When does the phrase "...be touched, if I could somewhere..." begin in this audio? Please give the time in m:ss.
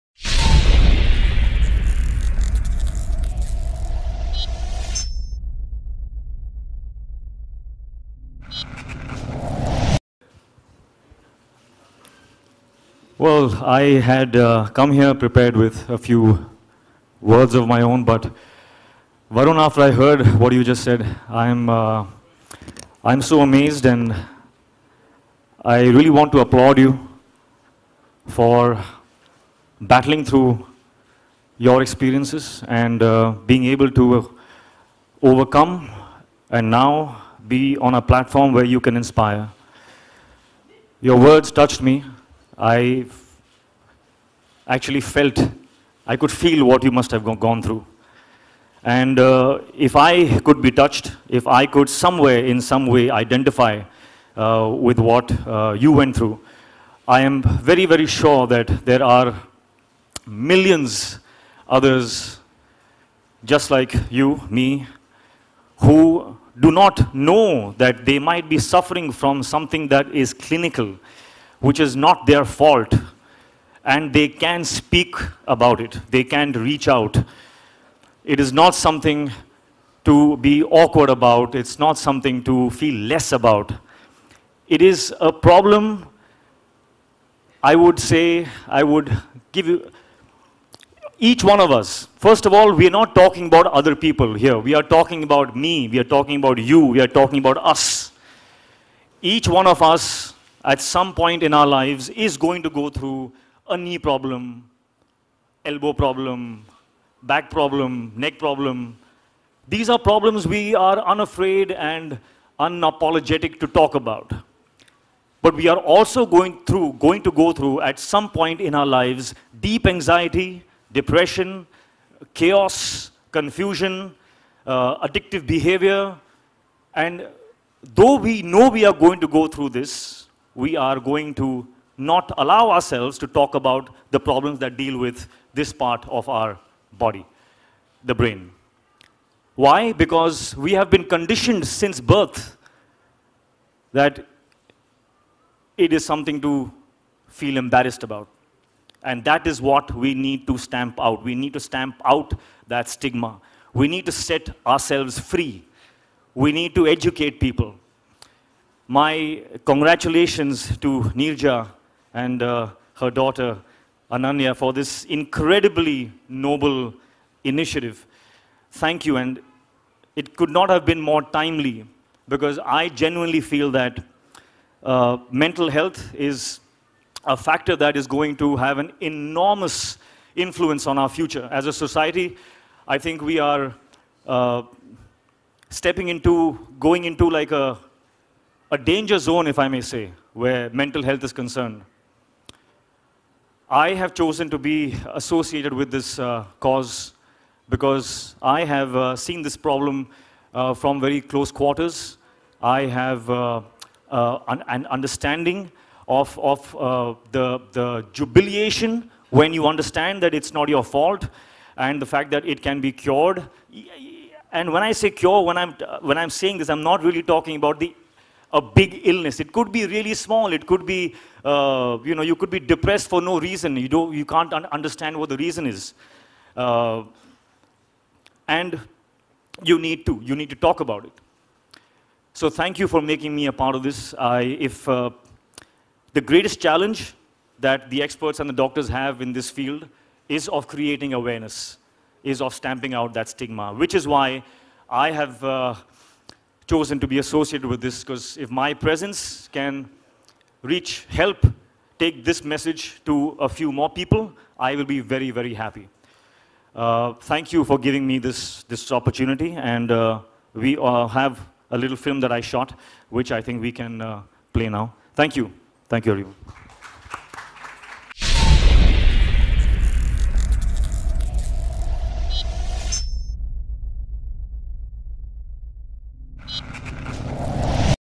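0:50.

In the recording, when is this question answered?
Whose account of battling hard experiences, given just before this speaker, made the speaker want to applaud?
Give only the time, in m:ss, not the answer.
0:19.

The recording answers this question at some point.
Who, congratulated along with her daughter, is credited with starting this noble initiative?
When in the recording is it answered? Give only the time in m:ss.
2:41.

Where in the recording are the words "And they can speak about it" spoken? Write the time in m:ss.
1:13.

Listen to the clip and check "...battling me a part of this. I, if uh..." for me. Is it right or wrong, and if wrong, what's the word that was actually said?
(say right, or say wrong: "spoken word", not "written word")
wrong: "making", not "battling".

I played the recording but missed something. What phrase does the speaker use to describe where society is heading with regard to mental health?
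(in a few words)
danger zone.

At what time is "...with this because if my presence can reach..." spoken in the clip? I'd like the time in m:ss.
4:07.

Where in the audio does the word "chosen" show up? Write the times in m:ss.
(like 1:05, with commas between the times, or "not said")
3:14, 4:06.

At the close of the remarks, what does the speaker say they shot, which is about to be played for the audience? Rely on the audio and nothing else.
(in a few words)
a little film.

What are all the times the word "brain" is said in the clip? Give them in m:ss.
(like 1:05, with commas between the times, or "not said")
2:18.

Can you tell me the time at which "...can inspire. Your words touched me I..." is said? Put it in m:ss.
0:38.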